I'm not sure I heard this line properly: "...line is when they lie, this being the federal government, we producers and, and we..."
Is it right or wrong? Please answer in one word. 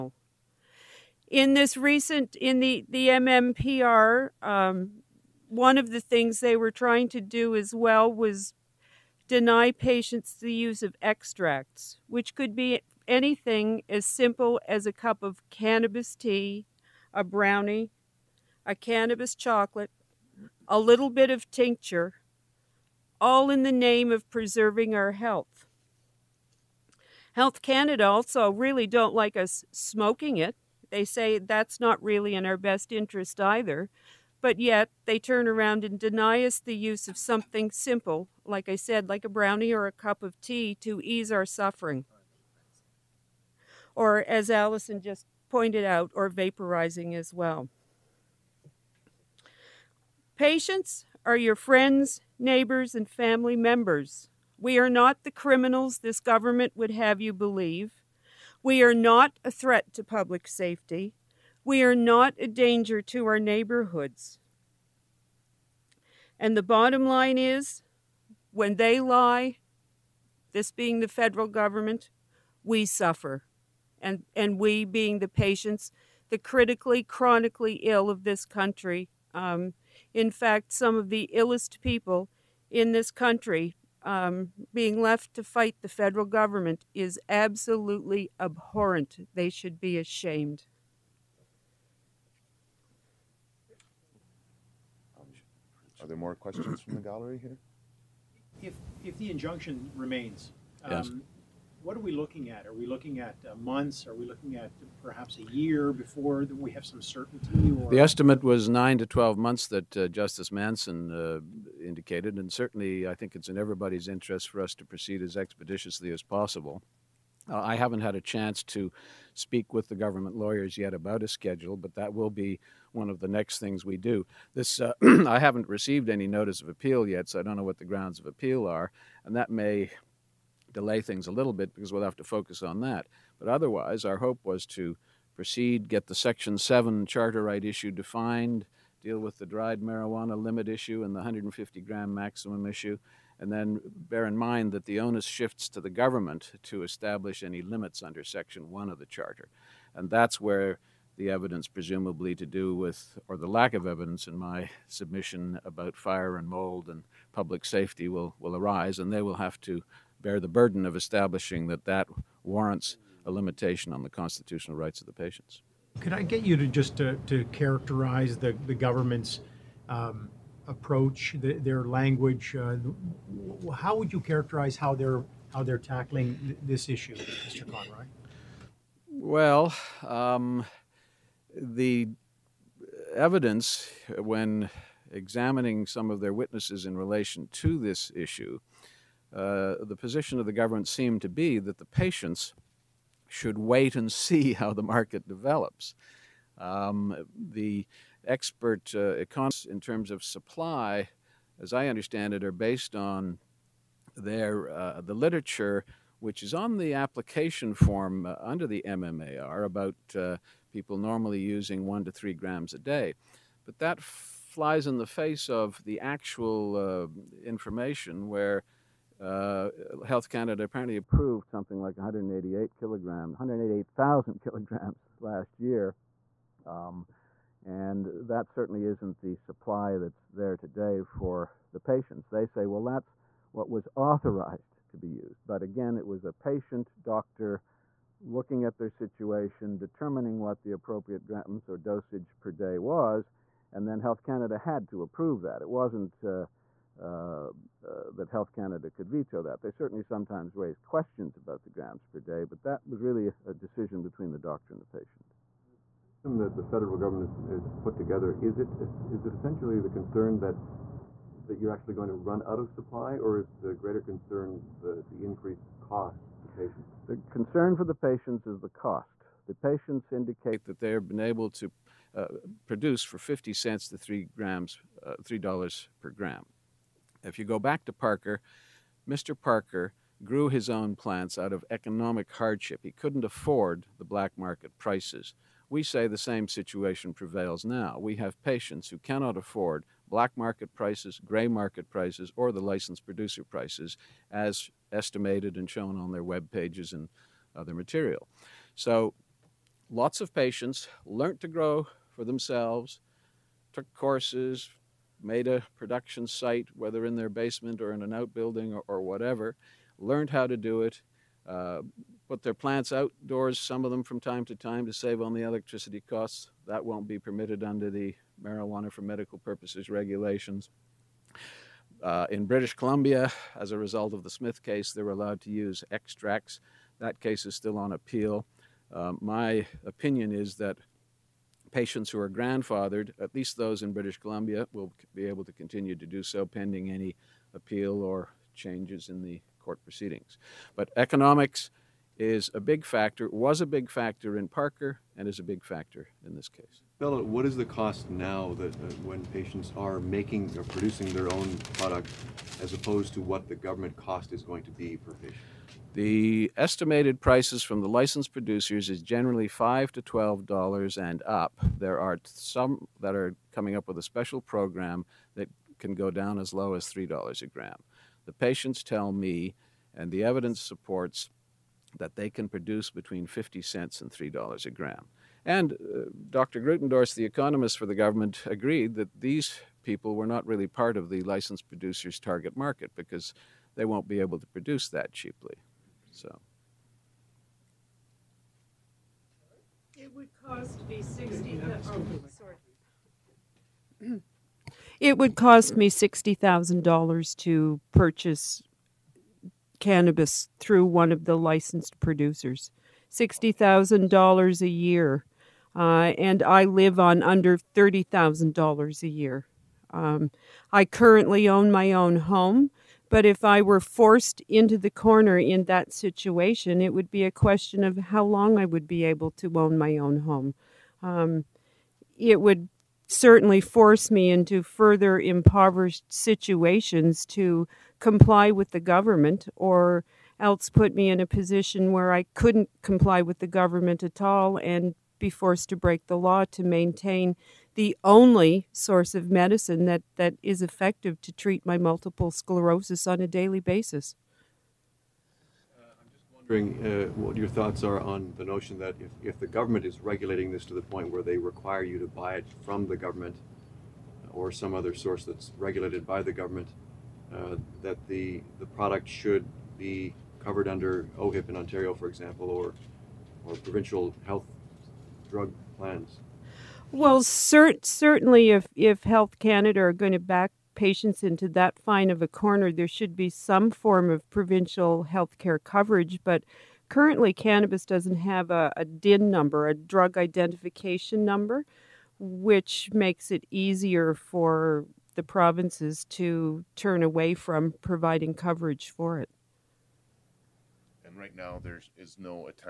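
wrong.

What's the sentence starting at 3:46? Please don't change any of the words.
Um, and that certainly isn't the supply that's there today for the patients.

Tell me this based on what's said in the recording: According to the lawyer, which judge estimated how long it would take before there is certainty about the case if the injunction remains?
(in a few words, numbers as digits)
Justice Manson.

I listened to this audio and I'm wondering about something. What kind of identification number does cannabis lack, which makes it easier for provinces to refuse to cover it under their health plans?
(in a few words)
DIN number.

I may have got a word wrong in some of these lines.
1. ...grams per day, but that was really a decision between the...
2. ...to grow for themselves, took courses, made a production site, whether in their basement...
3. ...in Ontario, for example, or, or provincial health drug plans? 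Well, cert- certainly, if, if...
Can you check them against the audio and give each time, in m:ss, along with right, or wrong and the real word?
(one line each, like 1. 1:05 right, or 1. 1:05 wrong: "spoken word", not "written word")
1. 4:11 right
2. 5:01 right
3. 7:41 right.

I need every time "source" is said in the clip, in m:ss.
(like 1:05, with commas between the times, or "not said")
7:18, 7:34.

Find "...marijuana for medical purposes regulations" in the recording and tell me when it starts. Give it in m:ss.
5:18.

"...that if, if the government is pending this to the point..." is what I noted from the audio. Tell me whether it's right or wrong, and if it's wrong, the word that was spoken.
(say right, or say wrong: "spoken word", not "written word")
wrong: "regulating", not "pending".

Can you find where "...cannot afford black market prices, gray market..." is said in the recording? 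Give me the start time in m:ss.
4:48.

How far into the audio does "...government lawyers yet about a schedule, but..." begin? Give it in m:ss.
1:59.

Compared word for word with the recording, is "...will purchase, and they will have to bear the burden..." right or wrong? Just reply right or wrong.
wrong.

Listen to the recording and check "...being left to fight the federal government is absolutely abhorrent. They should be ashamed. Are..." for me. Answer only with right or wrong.
right.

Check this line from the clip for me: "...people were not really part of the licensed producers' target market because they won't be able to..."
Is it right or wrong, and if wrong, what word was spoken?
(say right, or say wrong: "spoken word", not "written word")
right.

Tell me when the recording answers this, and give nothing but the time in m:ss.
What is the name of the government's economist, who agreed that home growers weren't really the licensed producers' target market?
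6:16.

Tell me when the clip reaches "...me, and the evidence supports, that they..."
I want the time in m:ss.
6:09.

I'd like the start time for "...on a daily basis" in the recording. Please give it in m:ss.
7:23.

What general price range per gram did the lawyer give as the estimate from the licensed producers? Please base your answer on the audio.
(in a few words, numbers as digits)
$5 to $12.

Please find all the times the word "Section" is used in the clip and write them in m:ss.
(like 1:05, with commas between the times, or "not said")
2:16, 2:28.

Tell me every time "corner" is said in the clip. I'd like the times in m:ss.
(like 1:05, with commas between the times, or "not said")
6:54, 7:52.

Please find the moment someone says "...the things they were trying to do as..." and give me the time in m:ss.
0:05.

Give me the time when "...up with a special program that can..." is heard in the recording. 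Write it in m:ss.
6:03.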